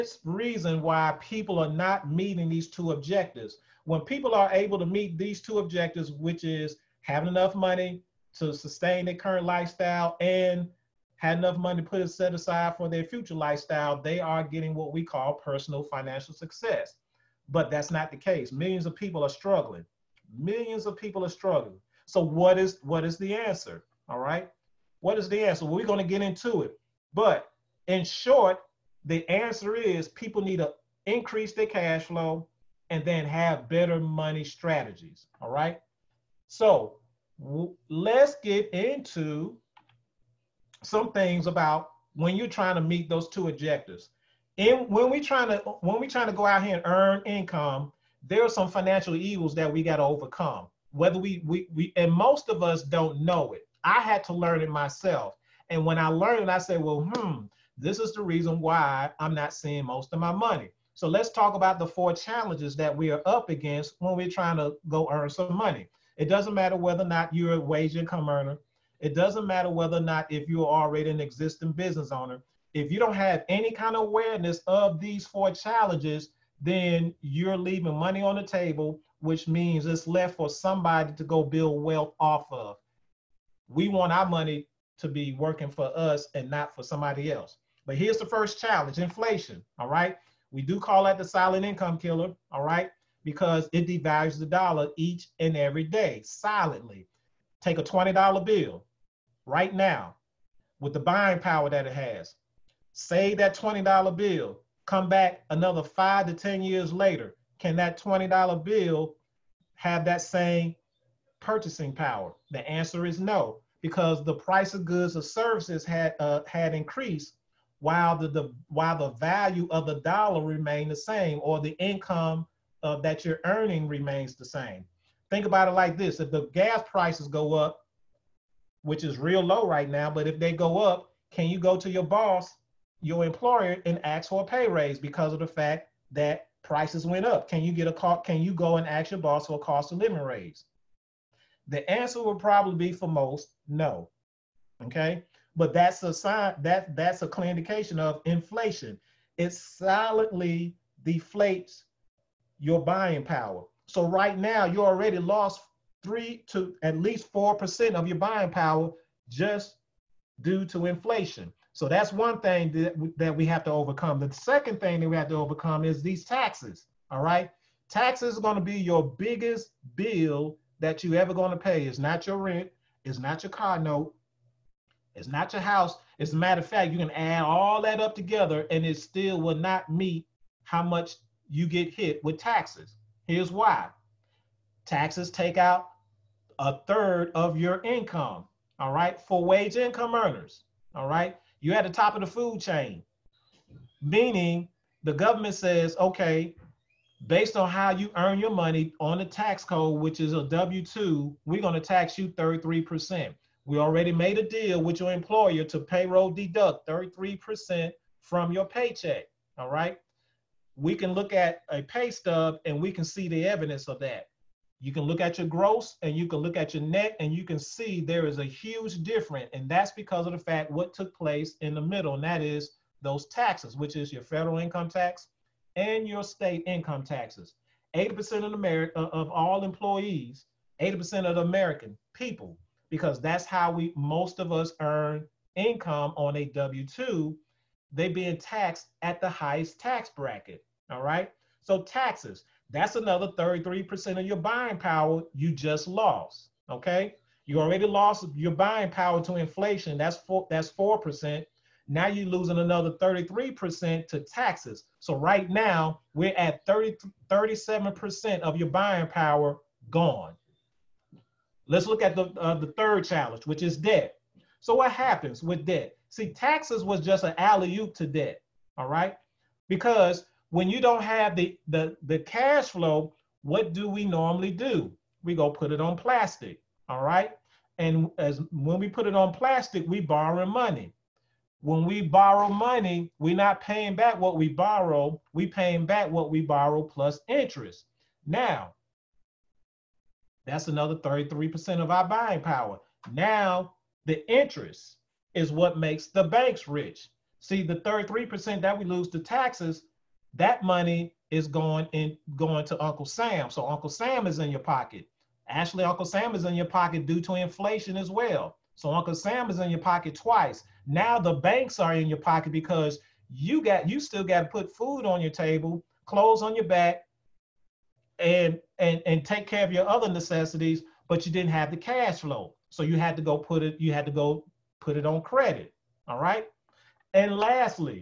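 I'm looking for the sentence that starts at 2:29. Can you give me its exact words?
It silently deflates your buying power.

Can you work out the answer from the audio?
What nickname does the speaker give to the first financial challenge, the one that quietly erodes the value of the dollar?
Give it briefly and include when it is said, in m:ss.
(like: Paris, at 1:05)
the silent income killer, at 1:31.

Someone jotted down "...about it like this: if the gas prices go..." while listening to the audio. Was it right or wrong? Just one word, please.
right.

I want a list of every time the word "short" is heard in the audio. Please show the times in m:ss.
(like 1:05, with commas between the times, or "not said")
0:28.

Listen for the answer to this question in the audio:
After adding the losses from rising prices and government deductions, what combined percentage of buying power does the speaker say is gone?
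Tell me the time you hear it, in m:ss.
4:17.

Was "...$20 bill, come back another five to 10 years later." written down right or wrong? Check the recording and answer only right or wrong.
right.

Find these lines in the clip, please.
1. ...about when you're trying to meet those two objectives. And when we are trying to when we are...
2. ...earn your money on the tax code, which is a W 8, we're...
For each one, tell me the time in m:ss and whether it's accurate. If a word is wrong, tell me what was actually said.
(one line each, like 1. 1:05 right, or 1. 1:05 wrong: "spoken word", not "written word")
1. 0:41 right
2. 3:18 wrong: "2", not "8".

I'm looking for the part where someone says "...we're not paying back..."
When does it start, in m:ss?
4:43.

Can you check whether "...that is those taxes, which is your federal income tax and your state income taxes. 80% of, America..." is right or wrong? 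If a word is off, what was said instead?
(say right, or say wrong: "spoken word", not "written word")
right.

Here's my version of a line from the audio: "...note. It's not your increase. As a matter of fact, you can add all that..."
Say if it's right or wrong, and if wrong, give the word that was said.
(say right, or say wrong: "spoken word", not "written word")
wrong: "house", not "increase".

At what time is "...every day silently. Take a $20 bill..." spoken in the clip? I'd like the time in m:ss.
1:35.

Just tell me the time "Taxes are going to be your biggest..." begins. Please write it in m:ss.
2:47.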